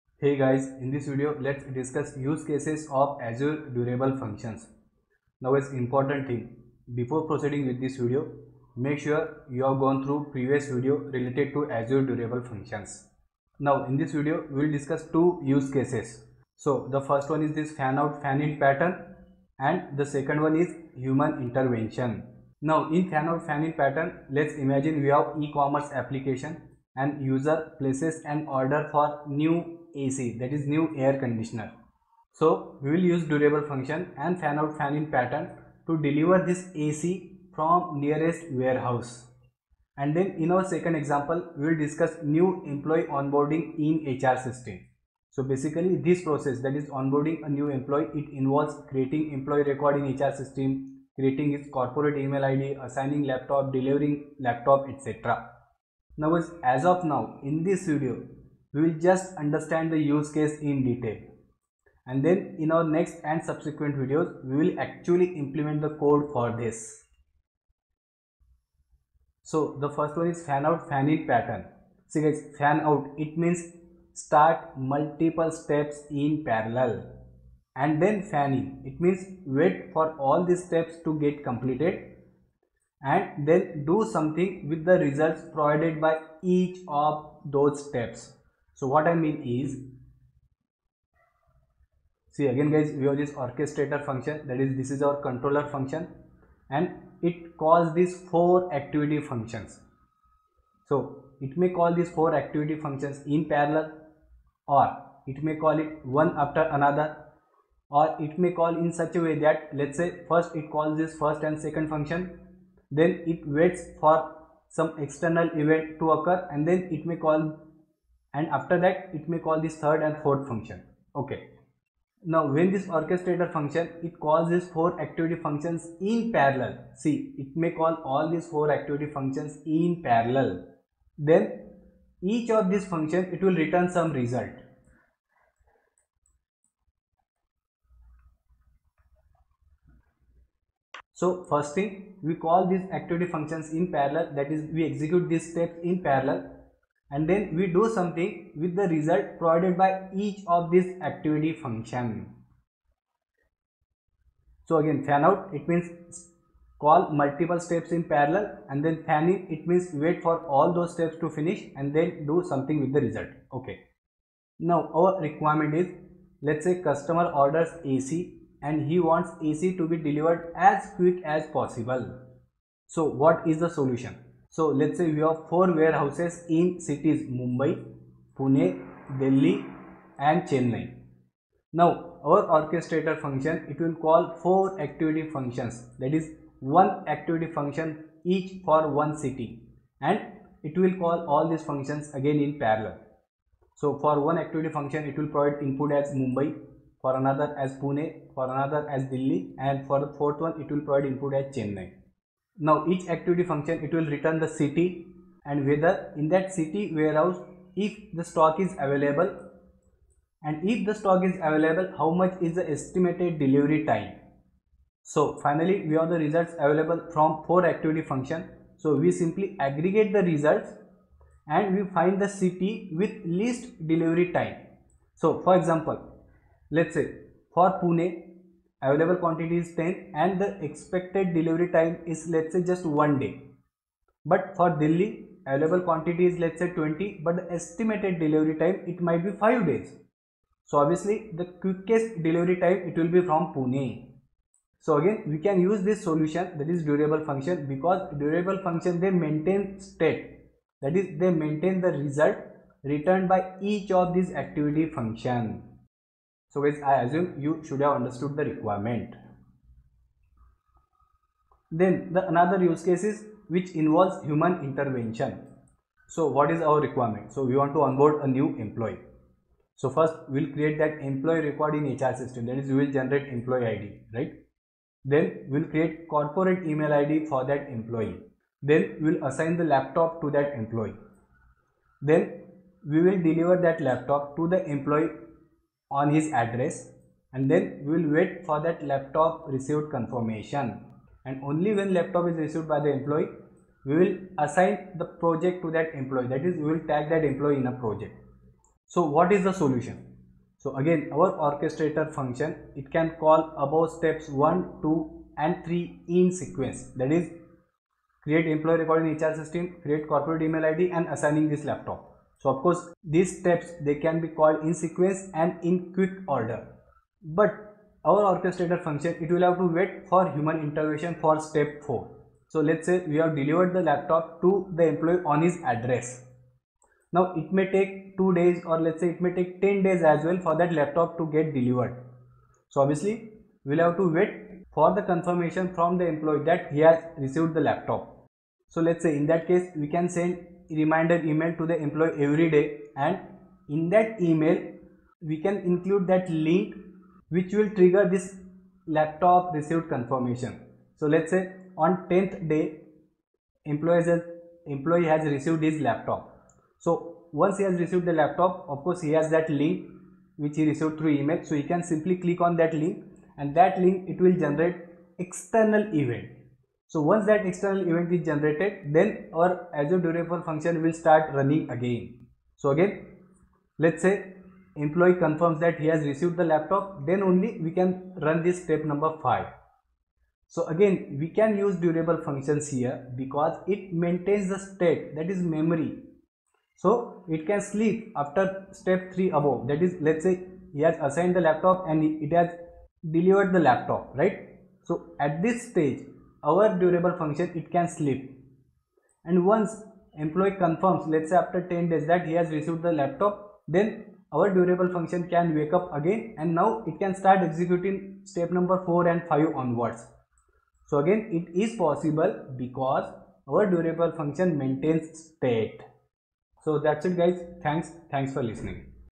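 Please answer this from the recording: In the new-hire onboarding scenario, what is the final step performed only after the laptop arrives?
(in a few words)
assign the project.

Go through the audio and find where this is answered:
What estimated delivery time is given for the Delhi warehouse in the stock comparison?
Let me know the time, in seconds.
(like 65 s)
239 s.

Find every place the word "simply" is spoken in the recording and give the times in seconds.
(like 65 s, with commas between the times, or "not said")
219 s, 361 s.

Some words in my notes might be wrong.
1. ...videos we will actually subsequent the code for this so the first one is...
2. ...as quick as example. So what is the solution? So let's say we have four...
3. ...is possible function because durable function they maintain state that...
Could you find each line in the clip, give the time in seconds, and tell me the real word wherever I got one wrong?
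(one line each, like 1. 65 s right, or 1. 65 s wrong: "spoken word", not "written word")
1. 64 s wrong: "implement", not "subsequent"
2. 170 s wrong: "possible", not "example"
3. 246 s wrong: "durable", not "possible".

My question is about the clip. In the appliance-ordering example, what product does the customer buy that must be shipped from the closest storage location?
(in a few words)
air conditioner.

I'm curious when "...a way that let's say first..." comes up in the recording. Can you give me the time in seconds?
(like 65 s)
109 s.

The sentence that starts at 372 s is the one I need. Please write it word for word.
So again, let's say employee confirms that he has received the laptop, then only we can run this step number 5.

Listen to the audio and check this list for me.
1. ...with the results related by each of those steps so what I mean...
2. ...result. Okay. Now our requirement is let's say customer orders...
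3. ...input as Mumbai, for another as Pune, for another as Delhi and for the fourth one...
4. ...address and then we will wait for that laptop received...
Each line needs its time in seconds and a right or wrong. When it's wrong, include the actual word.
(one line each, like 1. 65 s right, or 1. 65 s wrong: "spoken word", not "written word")
1. 84 s wrong: "provided", not "related"
2. 163 s right
3. 195 s right
4. 286 s right.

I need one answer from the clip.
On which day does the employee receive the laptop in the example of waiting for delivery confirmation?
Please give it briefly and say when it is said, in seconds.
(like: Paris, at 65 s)
10th day, at 352 s.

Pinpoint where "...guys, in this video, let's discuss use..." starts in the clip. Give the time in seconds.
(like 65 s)
0 s.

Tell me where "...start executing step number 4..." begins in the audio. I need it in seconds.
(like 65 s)
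407 s.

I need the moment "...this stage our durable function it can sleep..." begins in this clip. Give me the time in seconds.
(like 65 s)
395 s.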